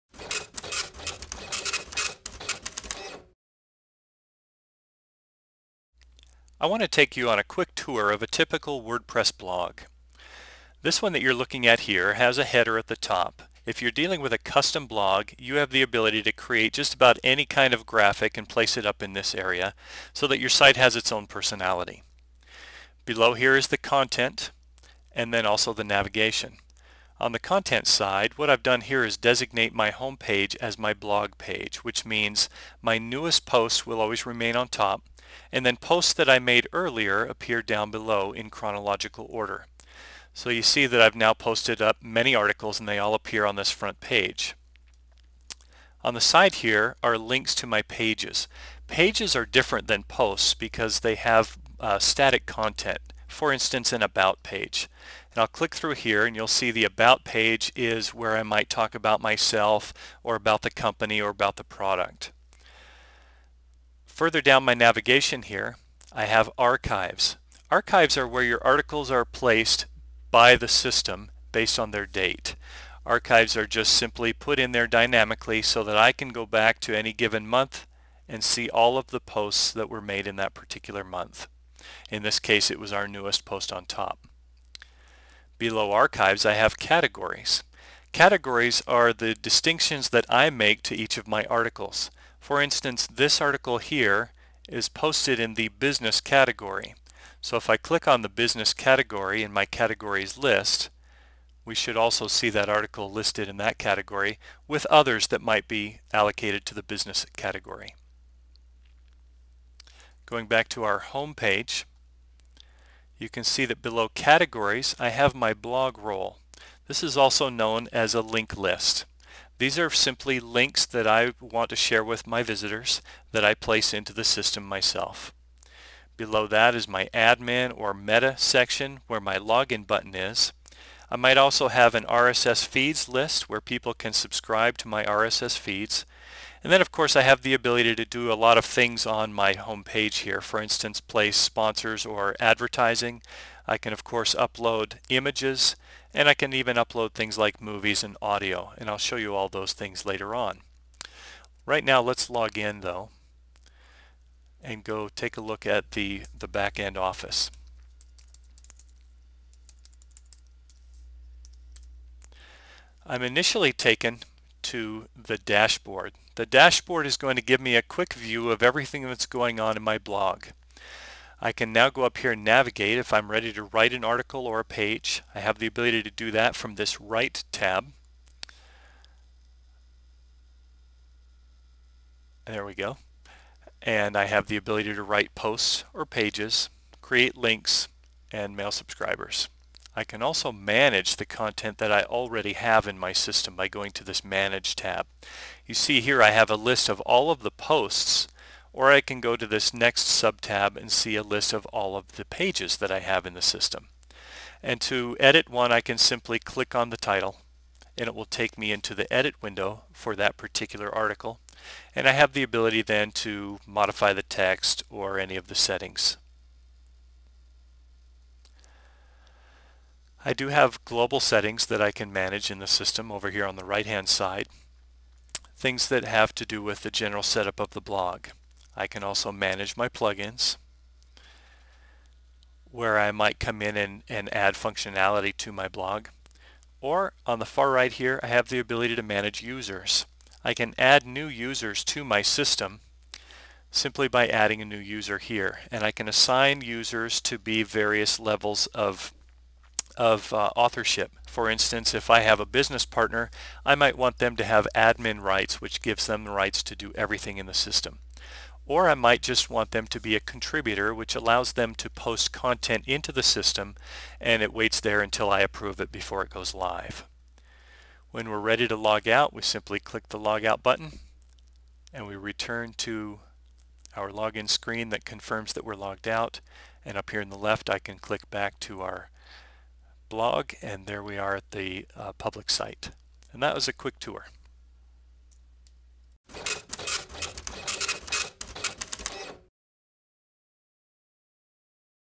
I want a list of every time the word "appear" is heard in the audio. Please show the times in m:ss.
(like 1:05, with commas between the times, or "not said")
0:37, 0:43.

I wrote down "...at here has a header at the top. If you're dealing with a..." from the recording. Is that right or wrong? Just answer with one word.
right.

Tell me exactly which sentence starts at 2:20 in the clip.
For instance, place sponsors or advertising.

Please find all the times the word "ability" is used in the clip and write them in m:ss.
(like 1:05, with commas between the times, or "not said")
0:15, 2:17, 2:55, 3:04, 3:32, 3:58.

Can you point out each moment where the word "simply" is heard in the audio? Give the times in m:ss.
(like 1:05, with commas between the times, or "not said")
1:13, 1:59, 3:25, 4:03, 4:29.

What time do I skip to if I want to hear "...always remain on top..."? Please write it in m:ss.
0:34.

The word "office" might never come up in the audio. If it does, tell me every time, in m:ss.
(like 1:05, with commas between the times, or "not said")
2:36.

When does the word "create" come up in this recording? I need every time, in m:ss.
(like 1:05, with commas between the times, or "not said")
0:16, 3:07.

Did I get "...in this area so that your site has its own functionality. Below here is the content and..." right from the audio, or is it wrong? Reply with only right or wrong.
wrong.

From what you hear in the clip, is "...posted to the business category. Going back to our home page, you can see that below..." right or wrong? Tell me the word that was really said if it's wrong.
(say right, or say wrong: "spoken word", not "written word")
wrong: "allocated", not "posted".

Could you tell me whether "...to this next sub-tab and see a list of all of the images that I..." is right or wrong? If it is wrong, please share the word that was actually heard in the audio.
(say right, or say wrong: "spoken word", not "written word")
wrong: "pages", not "images".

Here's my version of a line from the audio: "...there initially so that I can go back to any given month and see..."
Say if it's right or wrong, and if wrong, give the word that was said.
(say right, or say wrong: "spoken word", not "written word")
wrong: "dynamically", not "initially".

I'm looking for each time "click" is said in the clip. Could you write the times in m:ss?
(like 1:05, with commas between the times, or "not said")
0:55, 1:37, 3:26, 4:29, 4:37.